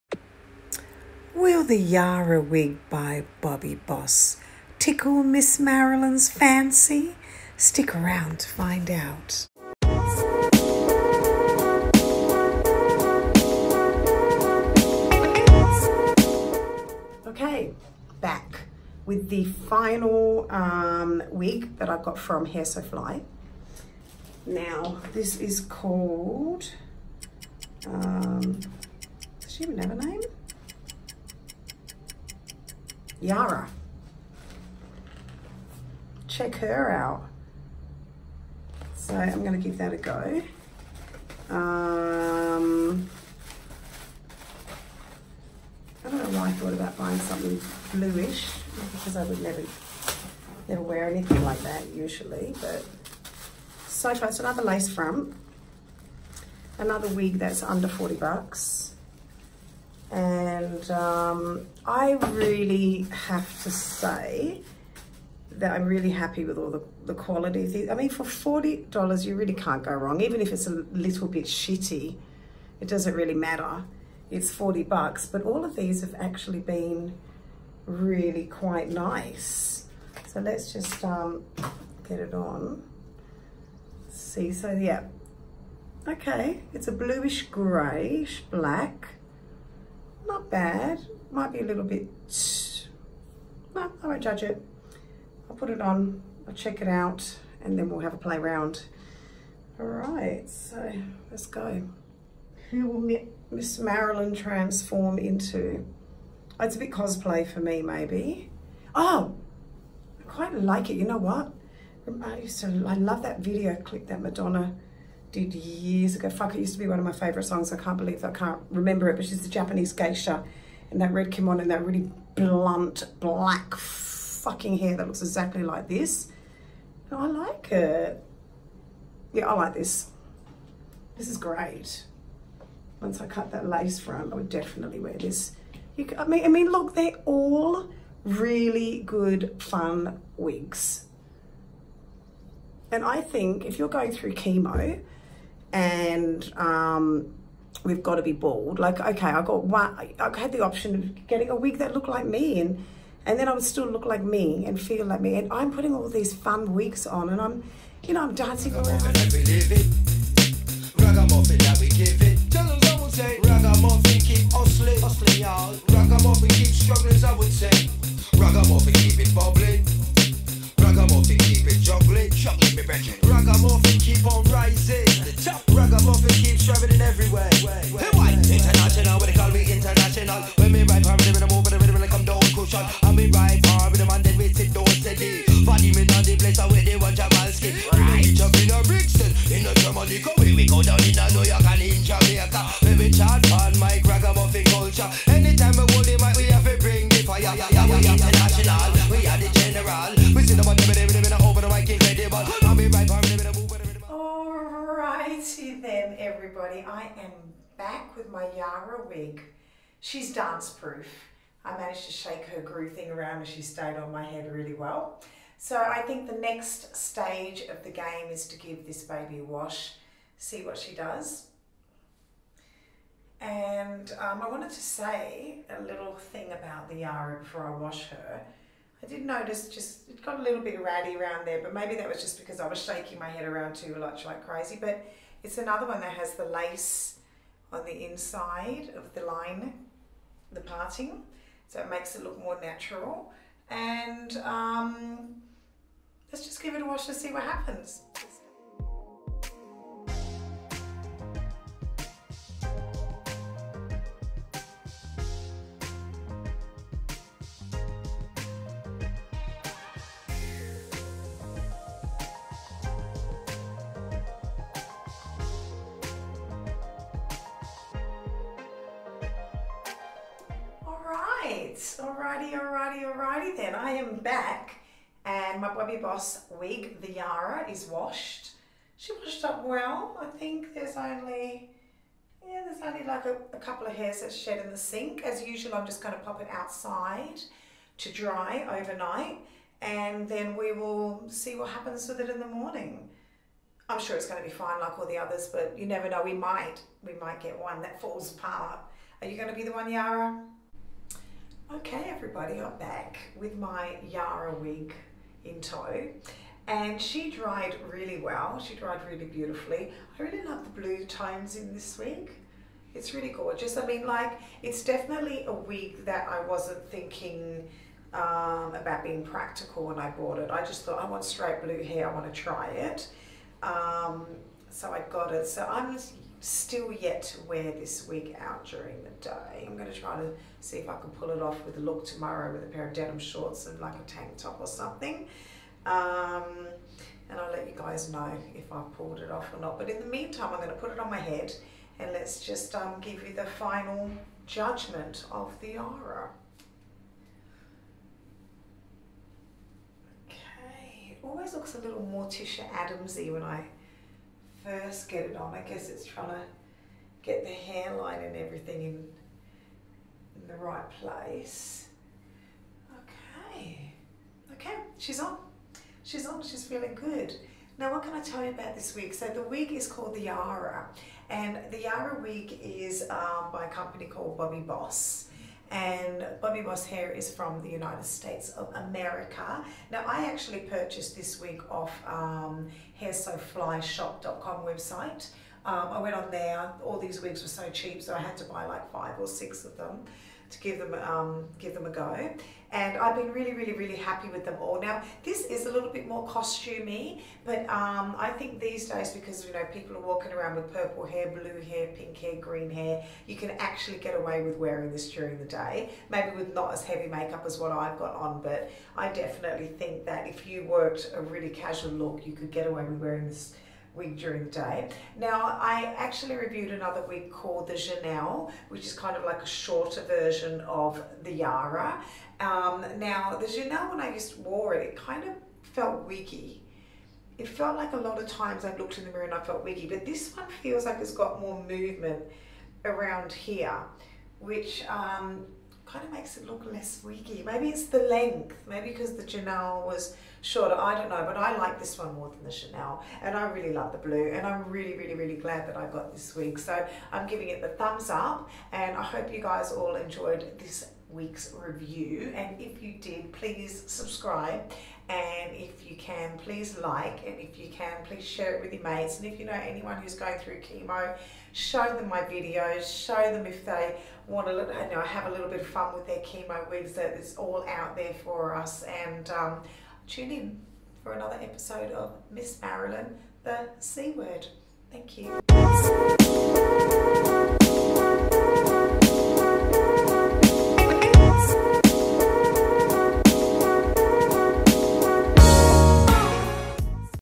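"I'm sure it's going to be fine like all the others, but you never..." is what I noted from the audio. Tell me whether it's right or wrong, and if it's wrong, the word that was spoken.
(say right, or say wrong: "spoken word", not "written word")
right.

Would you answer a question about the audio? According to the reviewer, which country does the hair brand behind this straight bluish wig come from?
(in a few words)
United States of America.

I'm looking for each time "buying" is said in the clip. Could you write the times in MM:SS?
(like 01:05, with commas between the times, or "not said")
00:46.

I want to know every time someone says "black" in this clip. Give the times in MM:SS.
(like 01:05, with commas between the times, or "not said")
01:28, 02:03.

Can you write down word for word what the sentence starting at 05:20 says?
I just thought, I want straight blue hair.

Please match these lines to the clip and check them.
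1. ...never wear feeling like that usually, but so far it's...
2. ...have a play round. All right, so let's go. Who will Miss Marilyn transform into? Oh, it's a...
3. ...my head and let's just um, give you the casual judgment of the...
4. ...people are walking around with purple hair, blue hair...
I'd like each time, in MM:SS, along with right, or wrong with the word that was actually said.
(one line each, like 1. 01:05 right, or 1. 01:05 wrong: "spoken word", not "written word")
1. 00:50 wrong: "anything", not "feeling"
2. 01:37 right
3. 05:41 wrong: "final", not "casual"
4. 06:39 right.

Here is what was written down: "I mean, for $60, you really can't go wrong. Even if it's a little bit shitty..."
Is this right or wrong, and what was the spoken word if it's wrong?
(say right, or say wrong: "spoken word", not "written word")
wrong: "40", not "60".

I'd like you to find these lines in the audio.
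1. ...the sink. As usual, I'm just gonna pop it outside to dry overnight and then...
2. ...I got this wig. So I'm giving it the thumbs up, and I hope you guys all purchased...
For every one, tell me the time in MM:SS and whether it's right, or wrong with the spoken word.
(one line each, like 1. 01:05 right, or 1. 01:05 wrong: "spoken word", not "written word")
1. 04:44 right
2. 07:25 wrong: "enjoyed", not "purchased".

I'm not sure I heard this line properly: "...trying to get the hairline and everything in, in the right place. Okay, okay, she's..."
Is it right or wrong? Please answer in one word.
right.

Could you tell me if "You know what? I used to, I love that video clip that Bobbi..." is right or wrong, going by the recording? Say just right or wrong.
wrong.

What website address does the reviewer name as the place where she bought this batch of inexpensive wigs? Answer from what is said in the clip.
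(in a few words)
hairsoflyshop.com.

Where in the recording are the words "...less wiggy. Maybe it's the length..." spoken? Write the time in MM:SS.
07:16.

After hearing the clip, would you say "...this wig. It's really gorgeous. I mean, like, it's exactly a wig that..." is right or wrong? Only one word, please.
wrong.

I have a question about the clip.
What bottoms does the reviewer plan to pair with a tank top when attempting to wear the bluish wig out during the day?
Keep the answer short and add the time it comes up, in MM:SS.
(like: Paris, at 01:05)
denim shorts, at 05:32.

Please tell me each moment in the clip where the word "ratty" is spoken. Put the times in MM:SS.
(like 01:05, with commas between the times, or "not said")
03:50.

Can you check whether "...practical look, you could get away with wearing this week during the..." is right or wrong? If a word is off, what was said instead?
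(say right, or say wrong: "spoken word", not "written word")
wrong: "casual", not "practical".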